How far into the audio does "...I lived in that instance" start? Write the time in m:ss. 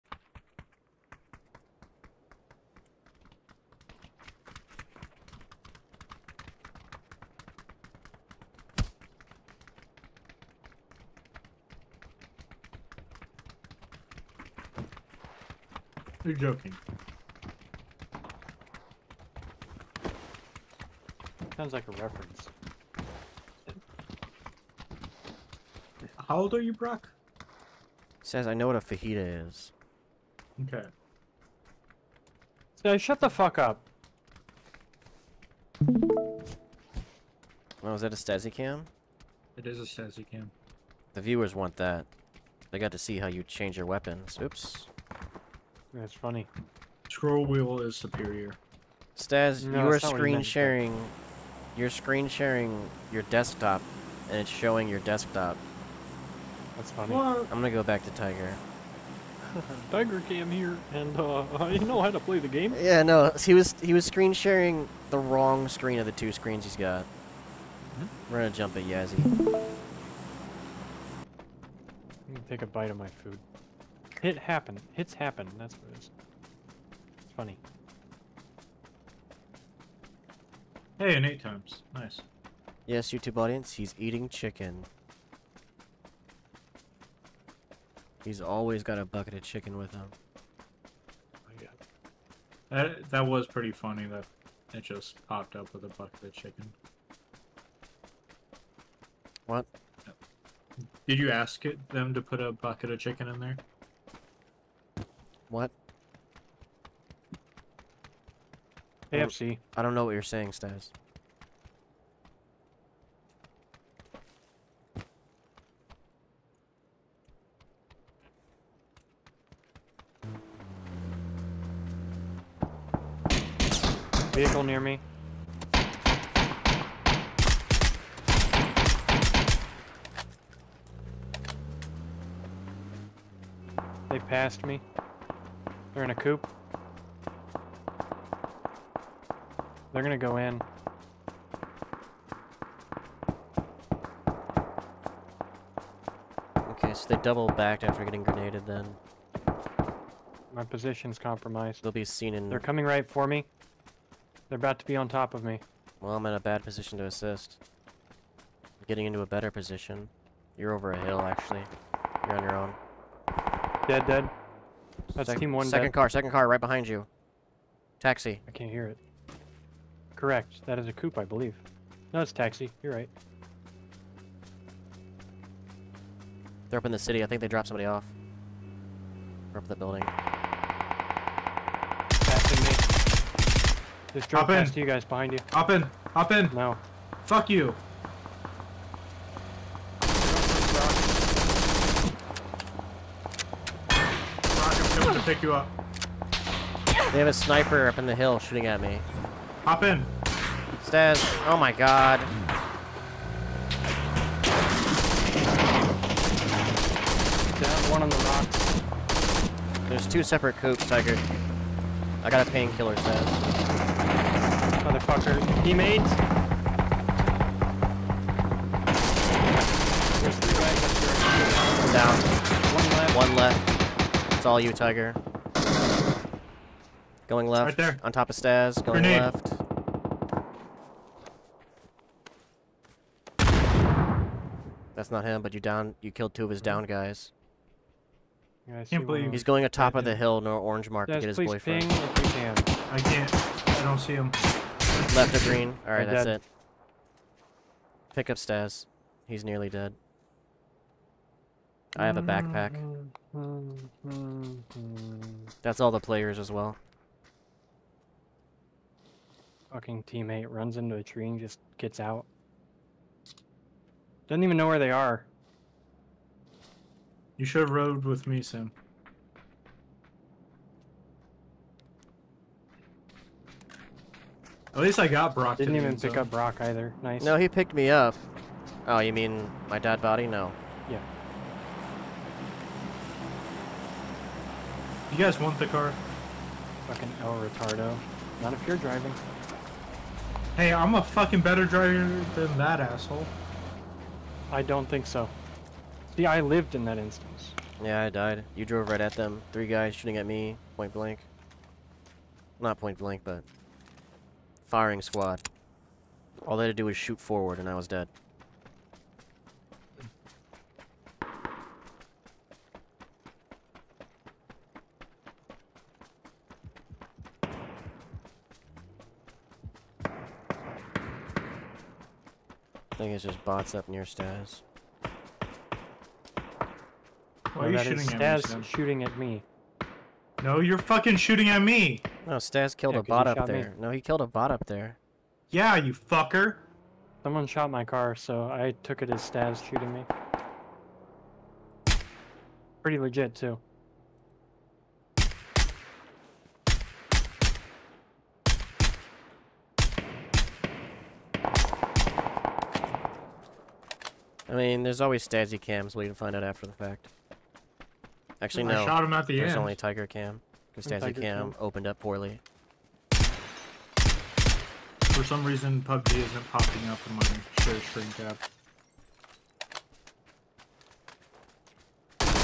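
4:56.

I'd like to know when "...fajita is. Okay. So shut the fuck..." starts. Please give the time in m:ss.
0:28.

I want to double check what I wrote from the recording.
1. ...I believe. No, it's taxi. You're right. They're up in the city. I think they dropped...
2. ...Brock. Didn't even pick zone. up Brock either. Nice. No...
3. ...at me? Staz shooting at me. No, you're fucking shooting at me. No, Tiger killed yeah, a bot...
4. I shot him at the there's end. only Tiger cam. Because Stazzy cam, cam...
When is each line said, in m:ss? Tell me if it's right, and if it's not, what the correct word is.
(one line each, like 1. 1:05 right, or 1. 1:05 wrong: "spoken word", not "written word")
1. 2:51 right
2. 4:35 right
3. 5:27 wrong: "Staz", not "Tiger"
4. 5:58 right.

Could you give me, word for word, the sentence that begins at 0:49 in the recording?
Stas, no, you are screen sharing.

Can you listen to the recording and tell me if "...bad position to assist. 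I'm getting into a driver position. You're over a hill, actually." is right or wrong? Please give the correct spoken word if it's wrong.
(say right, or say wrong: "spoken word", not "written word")
wrong: "better", not "driver".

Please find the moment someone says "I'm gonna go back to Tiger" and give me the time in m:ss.
0:57.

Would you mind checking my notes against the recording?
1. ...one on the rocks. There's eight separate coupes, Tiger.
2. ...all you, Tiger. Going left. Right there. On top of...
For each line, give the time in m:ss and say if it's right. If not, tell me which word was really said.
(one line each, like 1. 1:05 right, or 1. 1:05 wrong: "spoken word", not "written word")
1. 3:27 wrong: "two", not "eight"
2. 3:44 right.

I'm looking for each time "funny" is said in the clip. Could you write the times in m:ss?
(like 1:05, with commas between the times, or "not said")
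0:46, 0:56, 1:17, 1:33.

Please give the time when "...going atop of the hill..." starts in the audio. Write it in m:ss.
3:59.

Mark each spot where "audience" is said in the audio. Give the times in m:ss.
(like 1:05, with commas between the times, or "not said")
1:23.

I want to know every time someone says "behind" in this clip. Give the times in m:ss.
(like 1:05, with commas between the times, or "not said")
2:46, 3:05.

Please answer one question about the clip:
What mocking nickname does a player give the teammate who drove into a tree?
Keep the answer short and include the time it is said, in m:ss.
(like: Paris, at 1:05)
El Retardo, at 4:47.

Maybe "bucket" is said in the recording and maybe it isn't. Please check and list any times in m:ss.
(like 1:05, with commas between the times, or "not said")
1:29, 1:35, 1:42.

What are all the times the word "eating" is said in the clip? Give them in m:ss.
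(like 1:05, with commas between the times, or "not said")
1:23.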